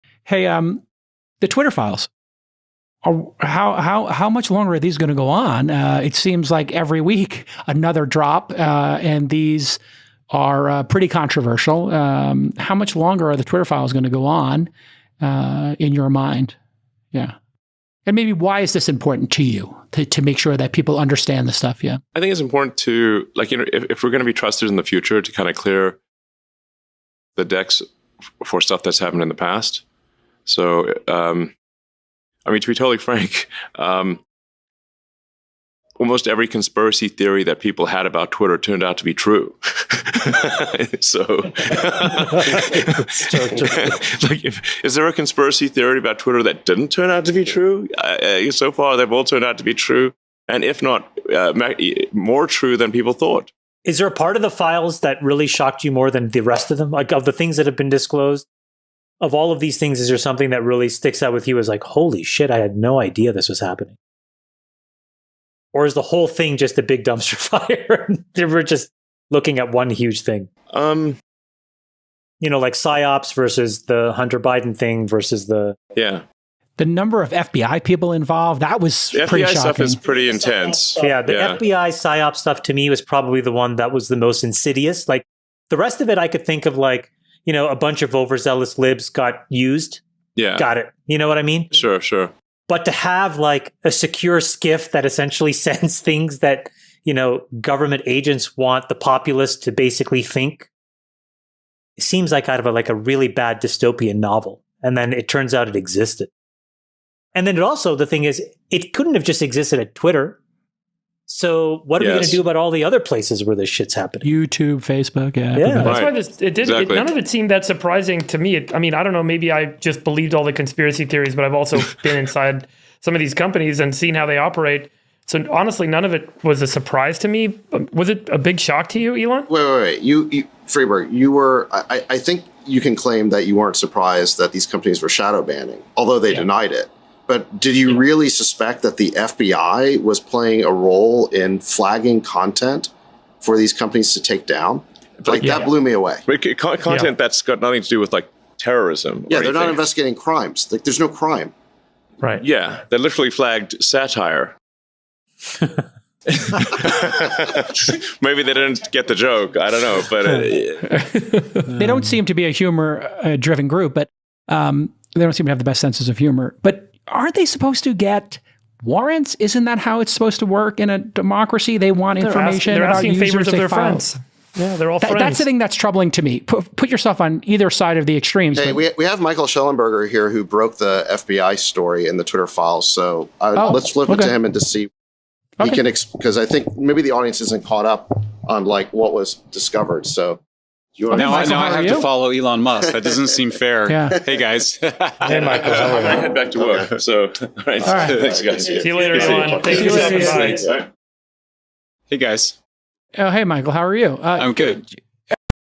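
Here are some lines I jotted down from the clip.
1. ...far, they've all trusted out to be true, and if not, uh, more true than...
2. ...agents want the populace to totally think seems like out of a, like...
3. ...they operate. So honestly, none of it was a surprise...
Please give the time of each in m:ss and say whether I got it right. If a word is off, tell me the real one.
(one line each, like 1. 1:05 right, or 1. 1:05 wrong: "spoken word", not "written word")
1. 0:48 wrong: "turned", not "trusted"
2. 1:38 wrong: "basically", not "totally"
3. 2:04 right.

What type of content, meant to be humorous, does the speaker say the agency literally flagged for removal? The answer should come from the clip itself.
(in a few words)
satire.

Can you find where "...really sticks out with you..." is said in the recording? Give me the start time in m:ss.
1:00.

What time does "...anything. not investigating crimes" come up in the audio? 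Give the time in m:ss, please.
2:29.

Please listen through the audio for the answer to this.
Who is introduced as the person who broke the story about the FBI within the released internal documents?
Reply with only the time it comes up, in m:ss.
2:59.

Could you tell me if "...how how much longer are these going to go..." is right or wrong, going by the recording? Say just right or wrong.
right.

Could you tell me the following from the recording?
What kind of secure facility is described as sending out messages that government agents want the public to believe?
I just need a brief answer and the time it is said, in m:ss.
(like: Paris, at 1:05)
SCIF, at 1:34.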